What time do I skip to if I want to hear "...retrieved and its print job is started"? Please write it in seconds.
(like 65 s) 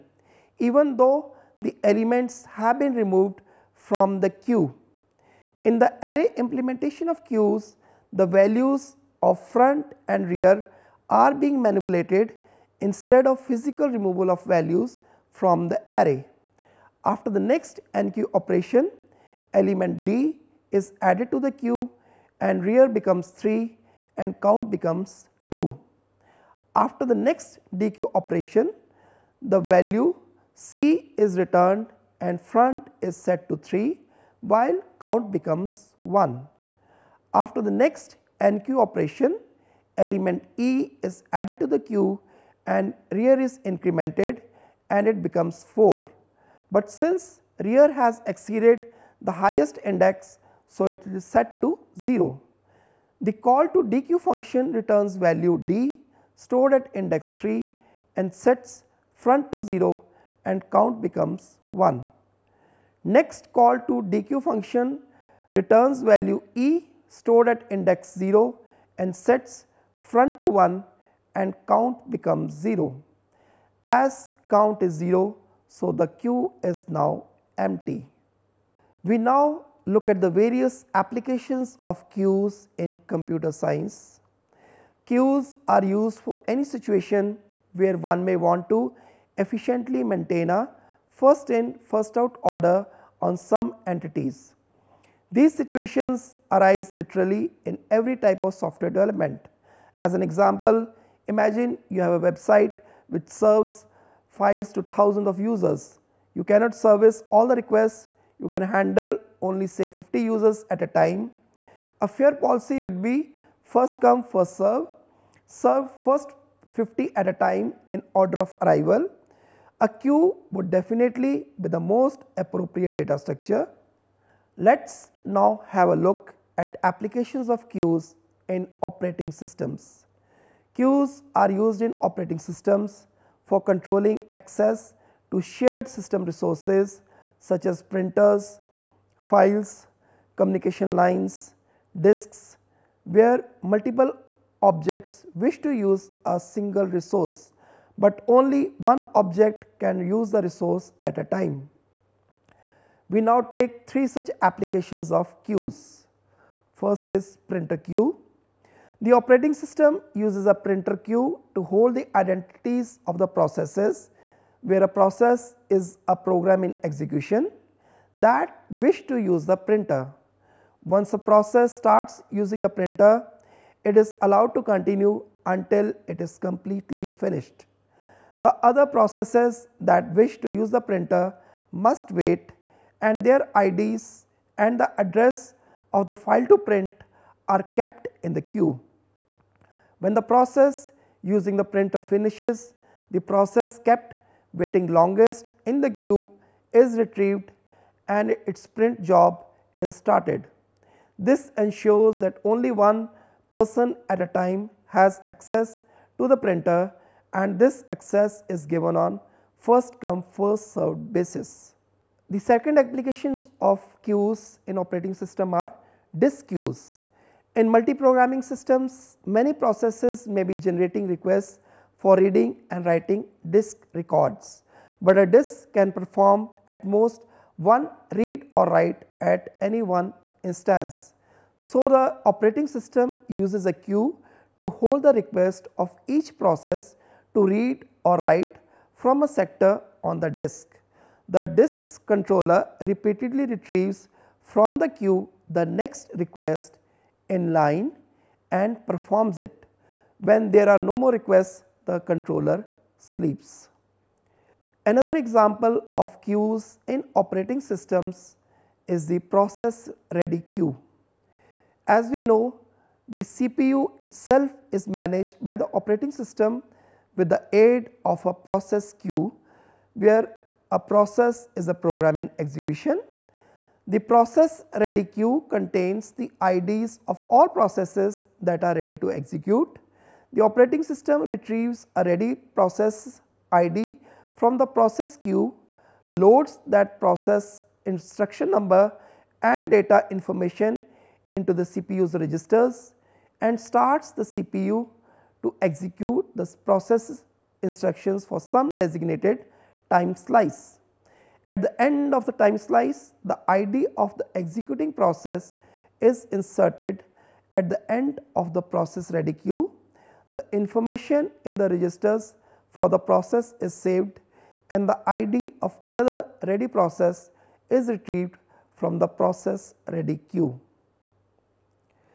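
196 s.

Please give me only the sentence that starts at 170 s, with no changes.
Once a process starts using the printer, it is allowed to continue until it is completely finished.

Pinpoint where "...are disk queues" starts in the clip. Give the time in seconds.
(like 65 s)
215 s.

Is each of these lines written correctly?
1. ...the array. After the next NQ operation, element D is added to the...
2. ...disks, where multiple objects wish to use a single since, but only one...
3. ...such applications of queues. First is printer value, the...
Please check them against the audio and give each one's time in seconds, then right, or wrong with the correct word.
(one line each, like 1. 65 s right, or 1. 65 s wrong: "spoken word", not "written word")
1. 15 s right
2. 141 s wrong: "resource", not "since"
3. 154 s wrong: "queue", not "value".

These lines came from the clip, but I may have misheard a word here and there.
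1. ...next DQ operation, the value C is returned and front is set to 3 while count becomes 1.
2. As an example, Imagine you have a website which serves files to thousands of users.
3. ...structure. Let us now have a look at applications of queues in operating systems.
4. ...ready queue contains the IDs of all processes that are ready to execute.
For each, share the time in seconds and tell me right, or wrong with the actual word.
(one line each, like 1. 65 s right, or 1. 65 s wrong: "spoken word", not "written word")
1. 27 s right
2. 99 s right
3. 123 s right
4. 274 s right.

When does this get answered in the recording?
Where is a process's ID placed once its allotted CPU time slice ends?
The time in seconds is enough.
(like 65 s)
307 s.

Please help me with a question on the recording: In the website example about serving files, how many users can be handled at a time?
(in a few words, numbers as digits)
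50.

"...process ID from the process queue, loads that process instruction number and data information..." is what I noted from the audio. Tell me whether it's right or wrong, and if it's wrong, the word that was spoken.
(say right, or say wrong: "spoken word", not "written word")
right.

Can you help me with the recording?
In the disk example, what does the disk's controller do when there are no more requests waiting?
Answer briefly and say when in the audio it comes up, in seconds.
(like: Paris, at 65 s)
sleeps, at 251 s.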